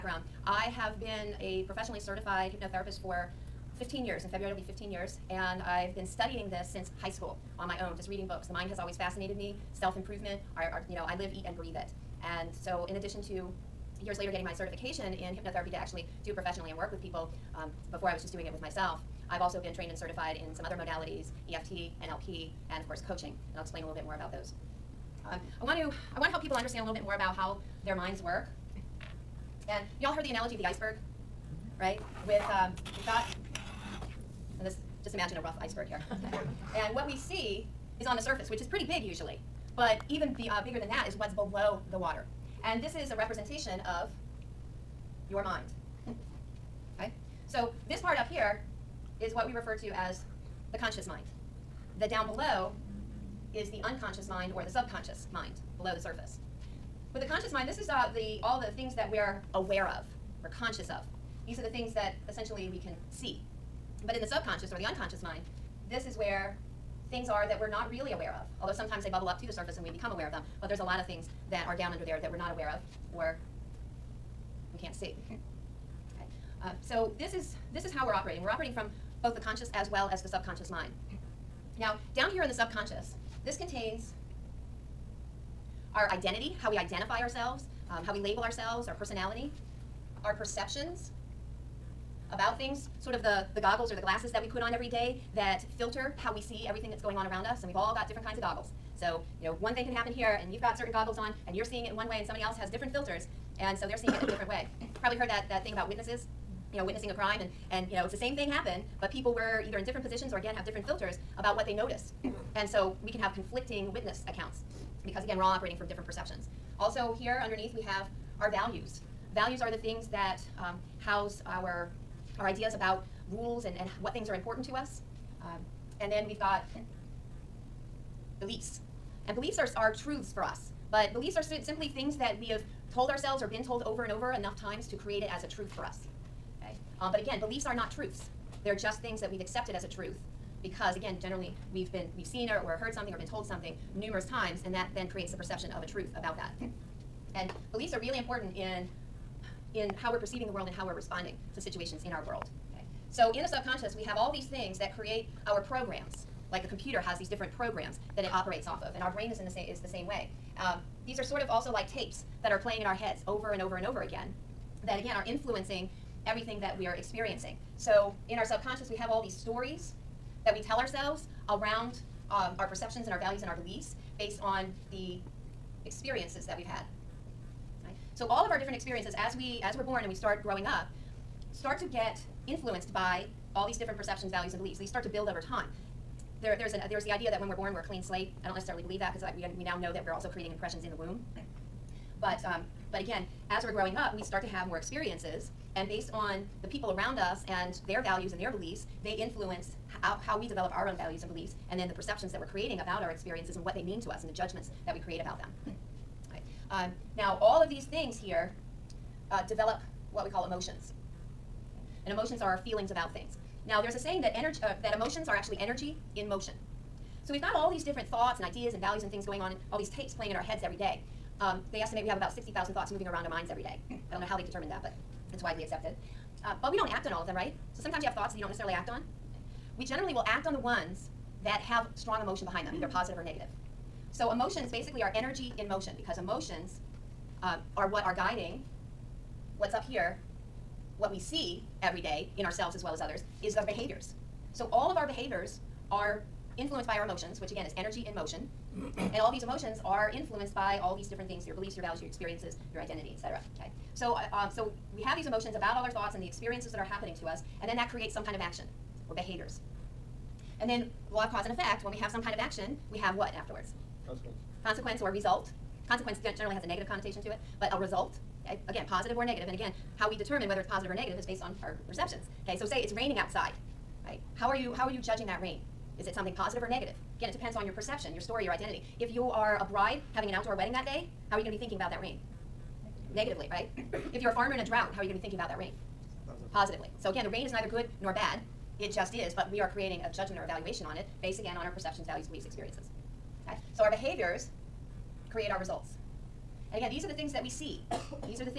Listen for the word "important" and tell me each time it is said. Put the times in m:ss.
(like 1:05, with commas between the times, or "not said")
2:04, 2:28.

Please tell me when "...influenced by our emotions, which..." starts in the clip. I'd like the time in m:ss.
4:06.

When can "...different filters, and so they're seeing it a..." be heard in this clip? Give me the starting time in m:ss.
1:42.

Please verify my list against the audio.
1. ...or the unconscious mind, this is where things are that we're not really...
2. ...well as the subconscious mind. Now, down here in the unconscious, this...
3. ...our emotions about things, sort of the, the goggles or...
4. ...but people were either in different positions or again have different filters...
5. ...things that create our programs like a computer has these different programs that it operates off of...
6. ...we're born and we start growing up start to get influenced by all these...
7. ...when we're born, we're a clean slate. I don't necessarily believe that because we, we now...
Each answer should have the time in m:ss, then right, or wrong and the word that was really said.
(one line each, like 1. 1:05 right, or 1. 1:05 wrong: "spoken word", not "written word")
1. 1:04 right
2. 1:19 wrong: "subconscious", not "unconscious"
3. 1:30 wrong: "perceptions", not "emotions"
4. 1:49 right
5. 2:34 right
6. 2:59 right
7. 3:07 right.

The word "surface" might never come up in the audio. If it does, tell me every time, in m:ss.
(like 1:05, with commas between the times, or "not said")
0:38, 0:56, 1:09.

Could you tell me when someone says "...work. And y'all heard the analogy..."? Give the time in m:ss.
0:28.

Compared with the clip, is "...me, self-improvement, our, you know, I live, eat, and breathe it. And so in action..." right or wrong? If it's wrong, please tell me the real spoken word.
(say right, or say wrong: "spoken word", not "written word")
wrong: "addition", not "action".